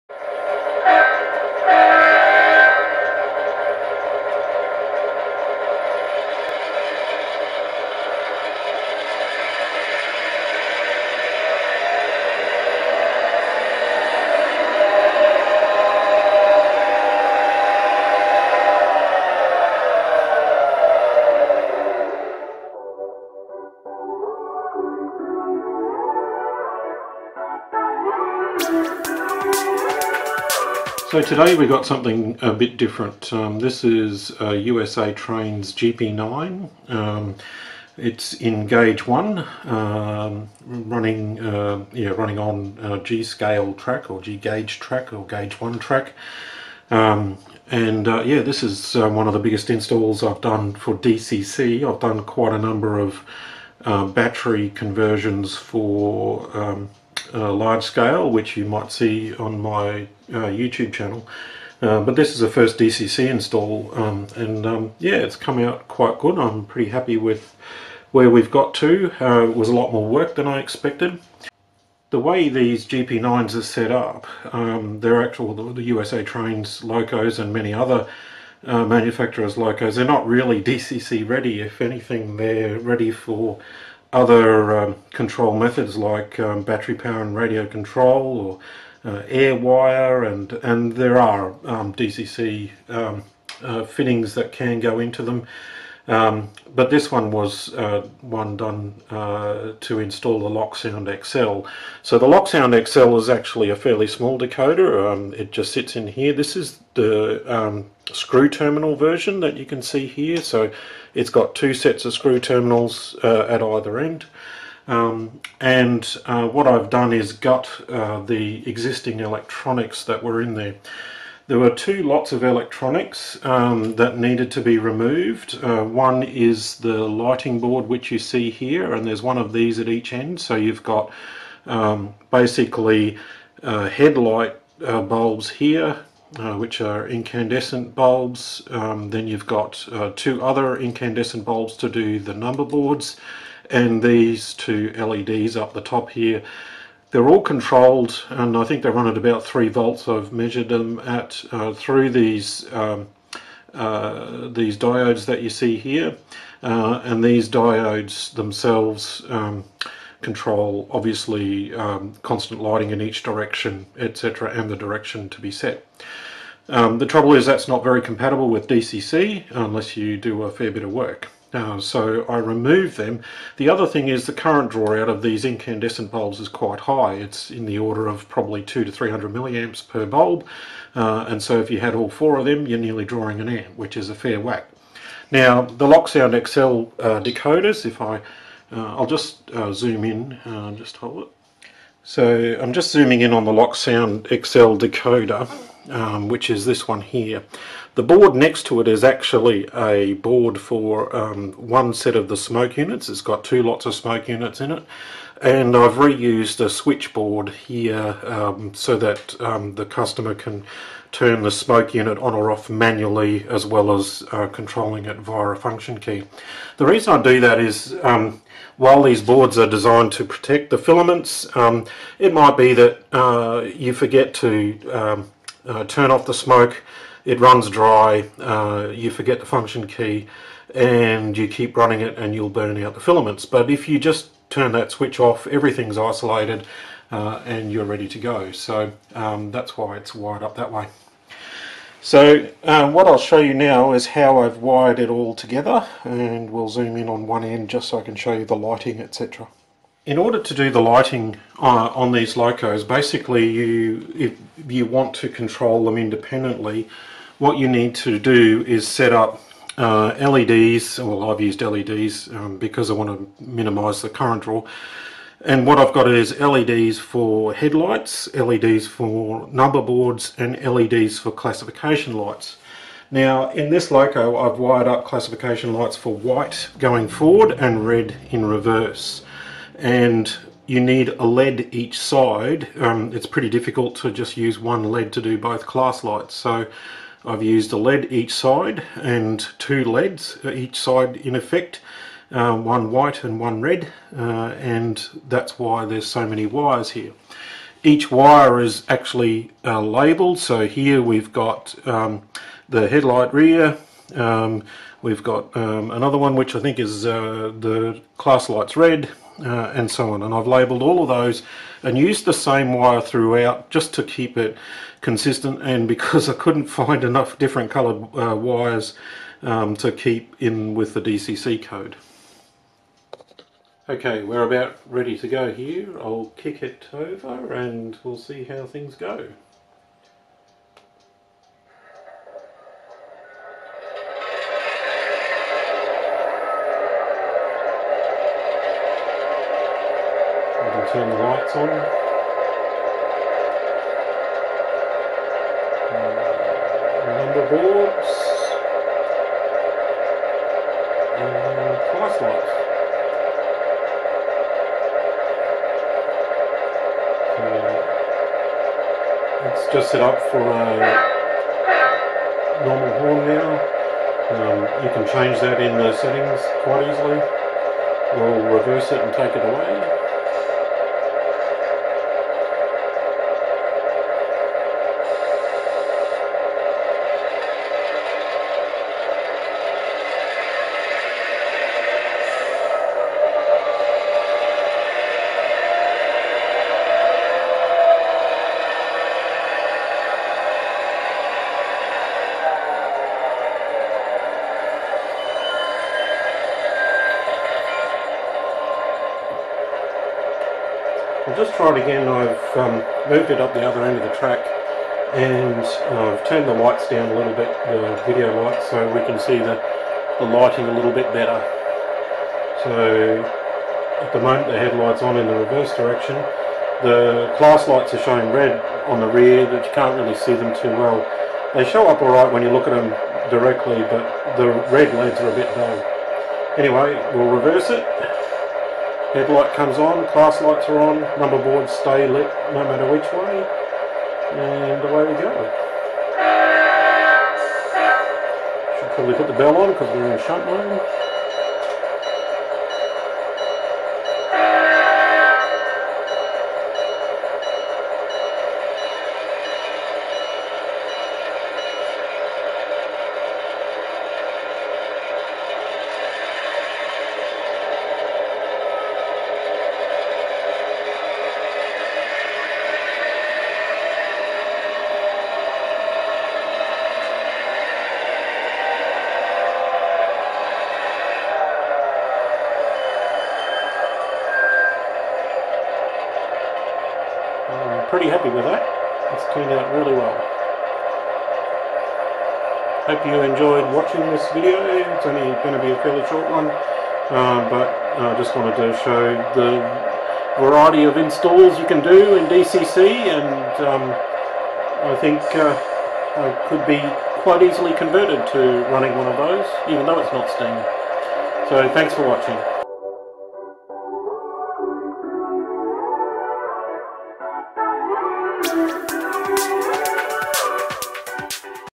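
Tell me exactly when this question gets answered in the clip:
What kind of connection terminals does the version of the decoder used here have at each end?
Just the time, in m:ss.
1:52.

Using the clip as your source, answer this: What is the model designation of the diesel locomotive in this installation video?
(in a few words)
GP9.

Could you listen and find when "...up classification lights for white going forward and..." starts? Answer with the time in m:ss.
4:34.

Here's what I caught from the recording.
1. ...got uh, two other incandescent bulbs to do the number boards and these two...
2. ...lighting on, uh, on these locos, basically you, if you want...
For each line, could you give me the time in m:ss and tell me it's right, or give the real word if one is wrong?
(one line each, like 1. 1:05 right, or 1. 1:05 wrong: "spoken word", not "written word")
1. 2:19 right
2. 4:10 right.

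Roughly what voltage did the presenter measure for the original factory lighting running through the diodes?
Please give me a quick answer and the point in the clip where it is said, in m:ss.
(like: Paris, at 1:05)
3 volts, at 2:29.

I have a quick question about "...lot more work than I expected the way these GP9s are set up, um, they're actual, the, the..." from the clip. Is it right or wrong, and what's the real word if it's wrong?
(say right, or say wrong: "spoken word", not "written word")
right.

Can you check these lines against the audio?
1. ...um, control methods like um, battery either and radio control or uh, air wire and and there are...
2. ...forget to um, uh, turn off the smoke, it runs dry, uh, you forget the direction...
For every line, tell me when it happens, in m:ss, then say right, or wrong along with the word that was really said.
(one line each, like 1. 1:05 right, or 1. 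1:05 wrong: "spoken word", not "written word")
1. 1:24 wrong: "power", not "either"
2. 3:43 wrong: "function", not "direction".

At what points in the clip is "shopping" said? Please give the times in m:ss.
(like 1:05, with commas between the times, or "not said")
not said.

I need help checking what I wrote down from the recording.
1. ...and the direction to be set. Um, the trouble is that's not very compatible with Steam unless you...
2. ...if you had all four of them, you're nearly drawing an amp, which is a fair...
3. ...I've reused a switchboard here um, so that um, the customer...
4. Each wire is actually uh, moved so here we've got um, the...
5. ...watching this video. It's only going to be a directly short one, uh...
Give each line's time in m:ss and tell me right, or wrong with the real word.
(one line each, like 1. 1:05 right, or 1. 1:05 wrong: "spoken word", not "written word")
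1. 2:44 wrong: "DCC", not "Steam"
2. 3:01 right
3. 3:25 right
4. 4:57 wrong: "labelled", not "moved"
5. 8:03 wrong: "fairly", not "directly".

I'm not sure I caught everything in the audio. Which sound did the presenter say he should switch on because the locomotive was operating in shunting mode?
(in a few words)
the bell.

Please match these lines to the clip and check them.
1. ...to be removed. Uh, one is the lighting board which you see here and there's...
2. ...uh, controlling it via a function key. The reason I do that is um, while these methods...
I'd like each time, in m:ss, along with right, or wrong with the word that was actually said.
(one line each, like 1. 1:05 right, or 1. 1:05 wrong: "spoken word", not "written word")
1. 2:04 right
2. 3:34 wrong: "boards", not "methods".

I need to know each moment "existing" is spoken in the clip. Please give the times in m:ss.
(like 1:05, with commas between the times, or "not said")
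1:58.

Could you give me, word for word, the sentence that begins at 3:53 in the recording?
But if you just turn that switch off, everything's isolated uh, and you're ready to go.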